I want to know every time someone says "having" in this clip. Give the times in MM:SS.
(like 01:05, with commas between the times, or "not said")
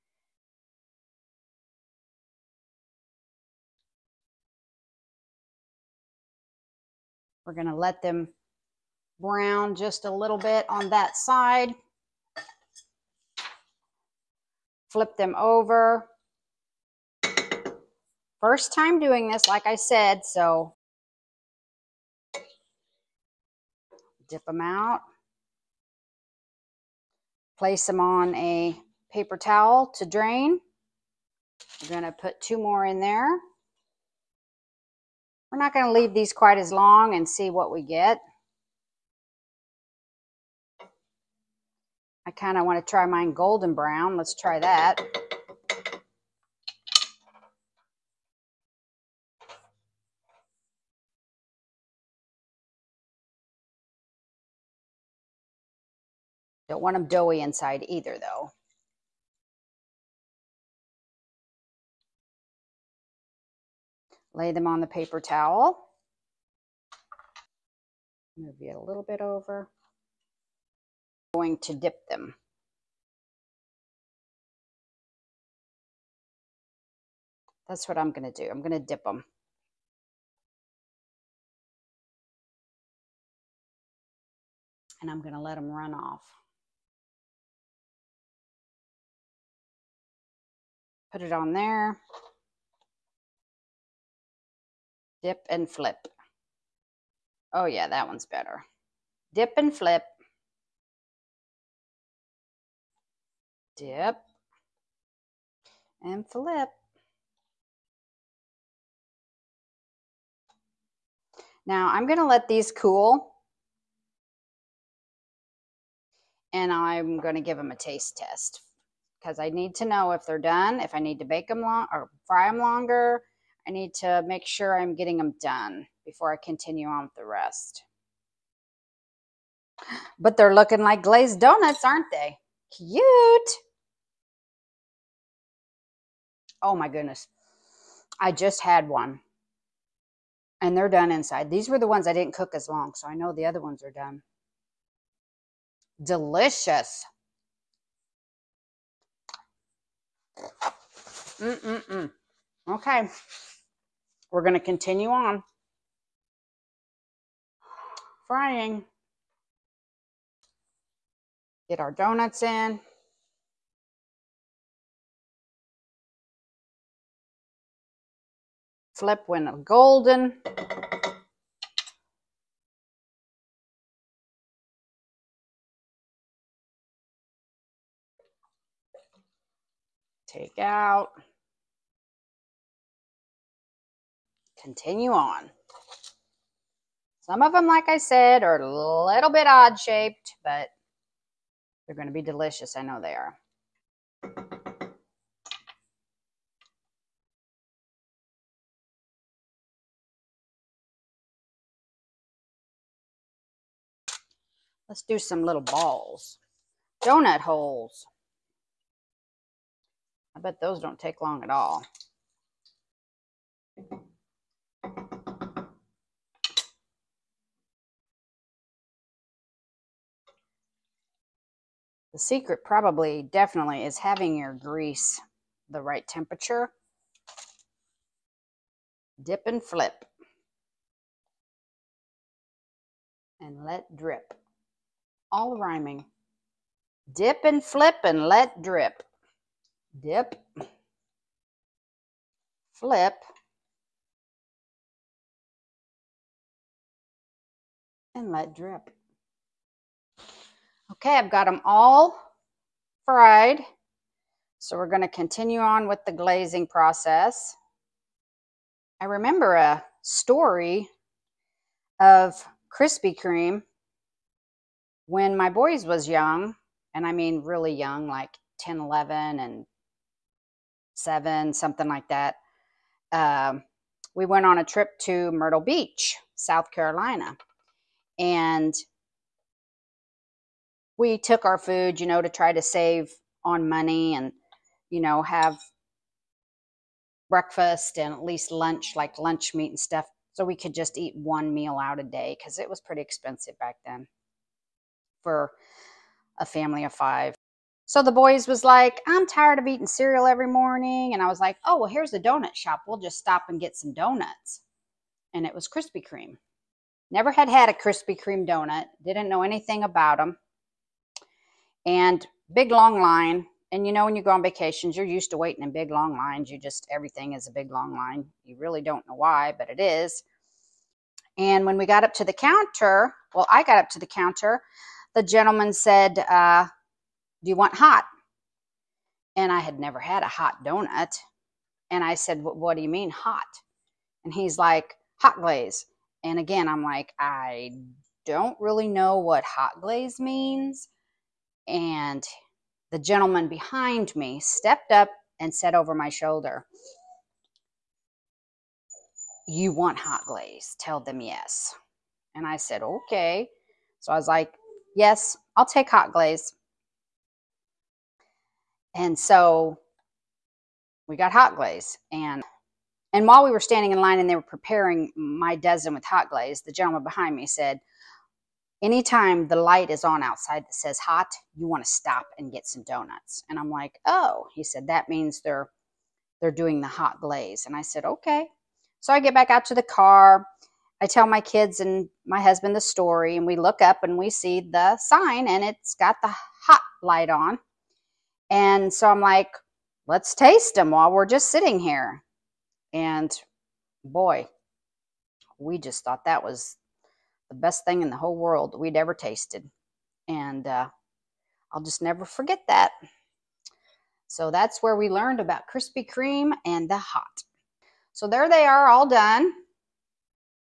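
03:43.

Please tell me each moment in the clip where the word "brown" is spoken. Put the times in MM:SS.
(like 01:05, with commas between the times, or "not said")
00:09, 00:43.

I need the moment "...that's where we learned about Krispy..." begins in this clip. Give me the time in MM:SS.
06:44.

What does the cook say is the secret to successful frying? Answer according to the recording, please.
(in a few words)
grease the right temperature.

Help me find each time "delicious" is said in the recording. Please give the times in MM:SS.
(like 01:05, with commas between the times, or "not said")
02:26, 03:12.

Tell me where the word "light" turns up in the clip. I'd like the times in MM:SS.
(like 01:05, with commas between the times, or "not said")
06:09, 06:27.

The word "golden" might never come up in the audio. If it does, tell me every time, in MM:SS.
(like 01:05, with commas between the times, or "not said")
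00:43, 02:49.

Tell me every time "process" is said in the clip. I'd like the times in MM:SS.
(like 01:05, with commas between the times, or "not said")
04:16.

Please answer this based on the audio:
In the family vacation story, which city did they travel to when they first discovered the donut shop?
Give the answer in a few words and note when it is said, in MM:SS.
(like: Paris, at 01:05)
Myrtle Beach, at 04:35.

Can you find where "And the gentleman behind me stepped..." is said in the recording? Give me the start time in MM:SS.
05:41.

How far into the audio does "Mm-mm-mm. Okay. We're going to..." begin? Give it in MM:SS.
02:31.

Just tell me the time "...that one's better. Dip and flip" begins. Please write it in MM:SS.
01:37.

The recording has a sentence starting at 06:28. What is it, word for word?
And so I'm like, let's taste them while we're just sitting here.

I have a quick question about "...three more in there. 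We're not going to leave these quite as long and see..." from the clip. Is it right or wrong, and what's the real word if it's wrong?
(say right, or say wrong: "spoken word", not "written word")
wrong: "two", not "three".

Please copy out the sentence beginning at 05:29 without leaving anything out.
And I had never had a hot donut.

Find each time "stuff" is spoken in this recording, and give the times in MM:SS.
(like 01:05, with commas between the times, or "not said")
04:49.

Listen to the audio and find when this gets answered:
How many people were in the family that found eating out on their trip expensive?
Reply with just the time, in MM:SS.
04:56.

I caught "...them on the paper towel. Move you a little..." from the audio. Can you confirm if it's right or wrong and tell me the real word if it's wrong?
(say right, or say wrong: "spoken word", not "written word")
right.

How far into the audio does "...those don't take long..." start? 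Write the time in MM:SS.
03:30.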